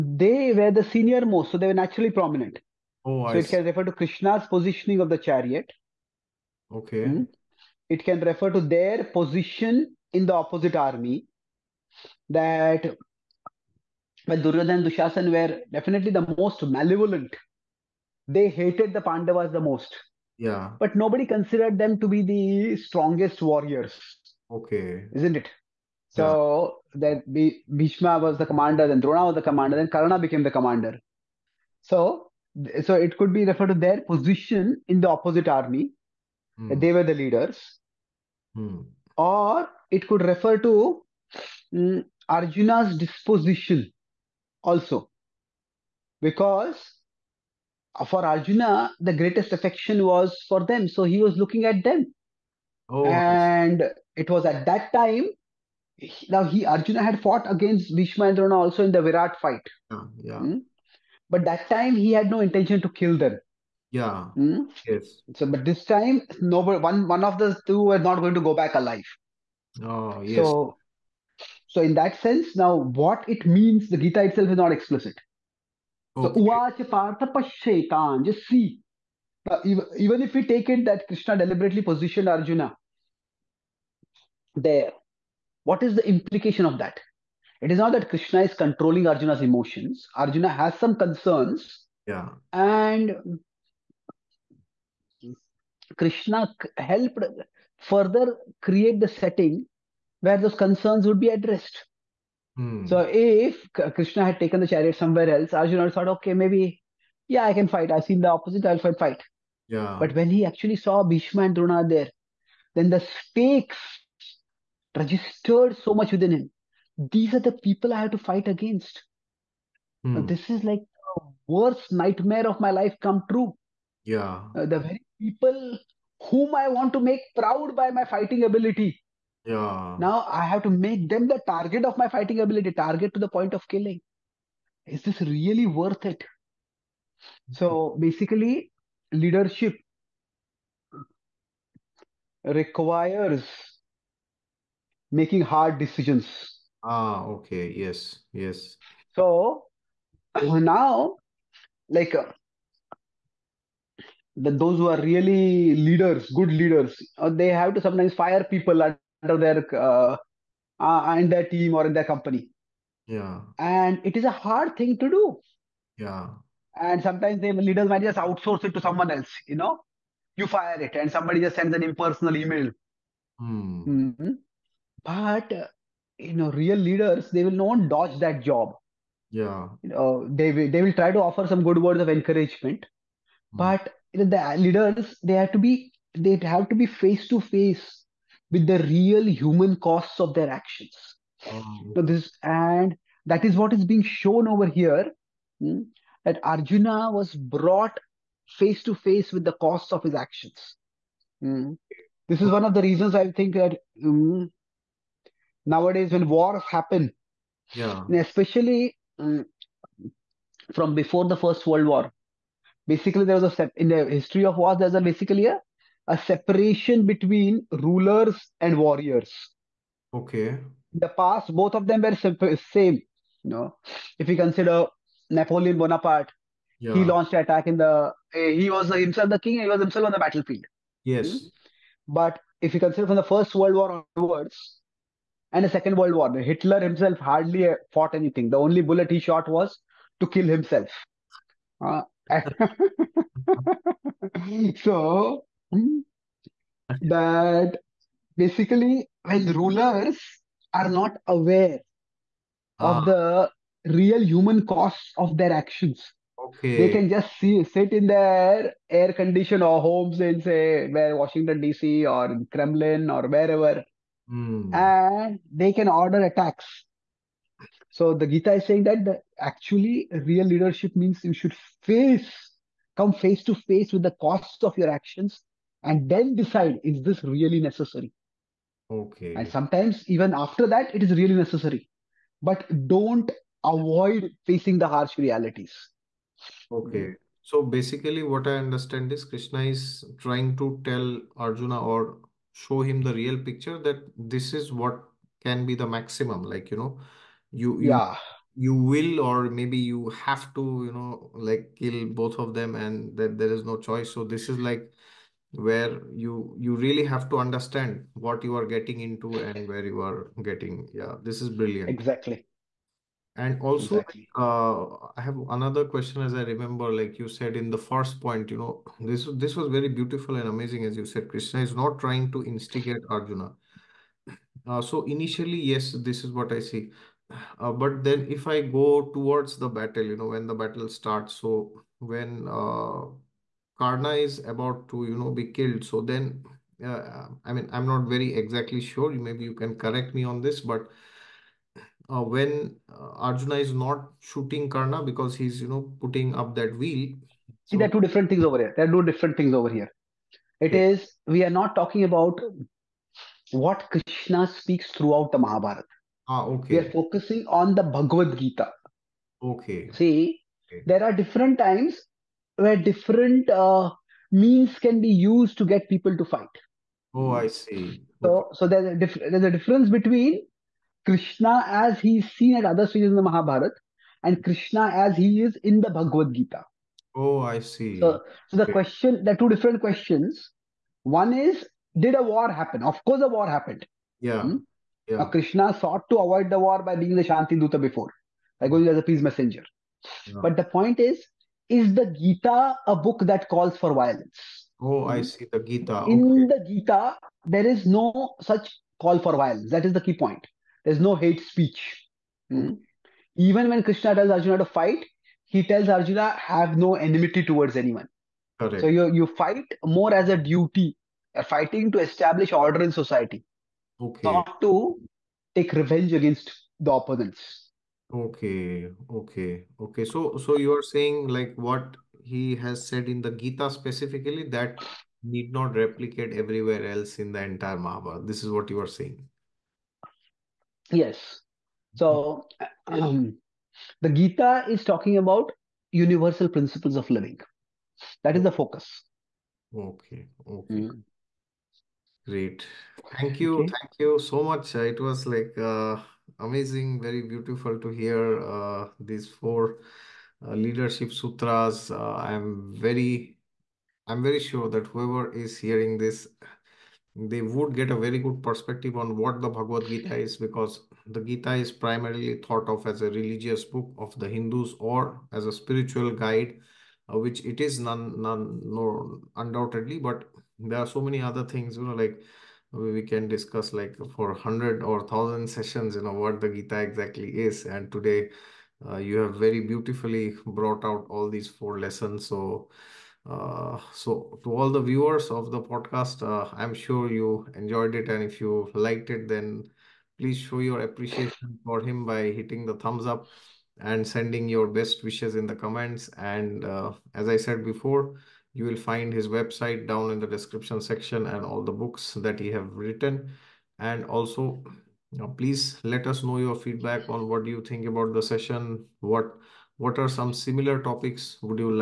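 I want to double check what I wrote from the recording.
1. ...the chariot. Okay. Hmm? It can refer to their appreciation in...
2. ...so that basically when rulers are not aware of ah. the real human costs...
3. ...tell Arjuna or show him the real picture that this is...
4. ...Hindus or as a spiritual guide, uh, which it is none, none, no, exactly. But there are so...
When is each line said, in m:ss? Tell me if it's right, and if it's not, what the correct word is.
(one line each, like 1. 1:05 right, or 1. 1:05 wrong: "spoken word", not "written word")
1. 0:05 wrong: "position", not "appreciation"
2. 4:04 right
3. 4:50 right
4. 7:44 wrong: "undoubtedly", not "exactly".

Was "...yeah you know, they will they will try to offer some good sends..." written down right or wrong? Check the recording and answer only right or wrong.
wrong.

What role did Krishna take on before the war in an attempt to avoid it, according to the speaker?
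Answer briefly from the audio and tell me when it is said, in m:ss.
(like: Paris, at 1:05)
Shanti Duta, at 6:27.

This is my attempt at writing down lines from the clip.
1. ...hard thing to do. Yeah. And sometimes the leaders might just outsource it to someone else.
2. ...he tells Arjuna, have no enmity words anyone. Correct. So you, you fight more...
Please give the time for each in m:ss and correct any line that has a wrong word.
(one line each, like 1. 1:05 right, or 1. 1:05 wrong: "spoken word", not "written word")
1. 2:44 right
2. 6:45 wrong: "towards", not "words".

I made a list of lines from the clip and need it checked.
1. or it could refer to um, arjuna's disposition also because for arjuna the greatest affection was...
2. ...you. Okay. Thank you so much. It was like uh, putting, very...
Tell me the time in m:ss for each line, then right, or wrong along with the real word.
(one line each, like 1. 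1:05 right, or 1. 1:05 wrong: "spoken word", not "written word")
1. 0:39 right
2. 7:23 wrong: "amazing", not "putting".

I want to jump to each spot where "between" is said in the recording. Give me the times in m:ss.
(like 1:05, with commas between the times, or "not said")
3:37, 6:09.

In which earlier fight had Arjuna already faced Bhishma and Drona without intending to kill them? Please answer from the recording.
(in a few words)
Virat fight.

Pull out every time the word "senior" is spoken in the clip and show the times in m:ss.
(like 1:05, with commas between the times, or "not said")
0:00.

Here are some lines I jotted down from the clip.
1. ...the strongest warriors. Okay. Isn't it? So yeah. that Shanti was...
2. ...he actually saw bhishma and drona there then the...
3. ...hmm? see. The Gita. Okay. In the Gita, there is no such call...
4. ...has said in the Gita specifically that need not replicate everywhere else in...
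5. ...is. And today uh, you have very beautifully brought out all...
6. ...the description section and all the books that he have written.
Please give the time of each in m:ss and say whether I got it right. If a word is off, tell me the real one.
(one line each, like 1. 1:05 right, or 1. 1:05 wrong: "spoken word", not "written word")
1. 0:22 wrong: "Bhishma", not "Shanti"
2. 1:50 right
3. 6:35 right
4. 7:02 right
5. 7:57 right
6. 8:20 right.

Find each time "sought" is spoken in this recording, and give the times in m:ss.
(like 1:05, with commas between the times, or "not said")
6:25.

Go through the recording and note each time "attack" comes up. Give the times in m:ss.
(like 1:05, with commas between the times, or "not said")
3:47, 4:26.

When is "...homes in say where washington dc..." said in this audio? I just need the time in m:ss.
4:19.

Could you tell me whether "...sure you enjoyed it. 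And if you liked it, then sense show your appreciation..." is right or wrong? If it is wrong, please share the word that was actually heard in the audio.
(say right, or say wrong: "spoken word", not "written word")
wrong: "please", not "sense".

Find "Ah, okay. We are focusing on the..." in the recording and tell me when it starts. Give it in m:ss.
5:56.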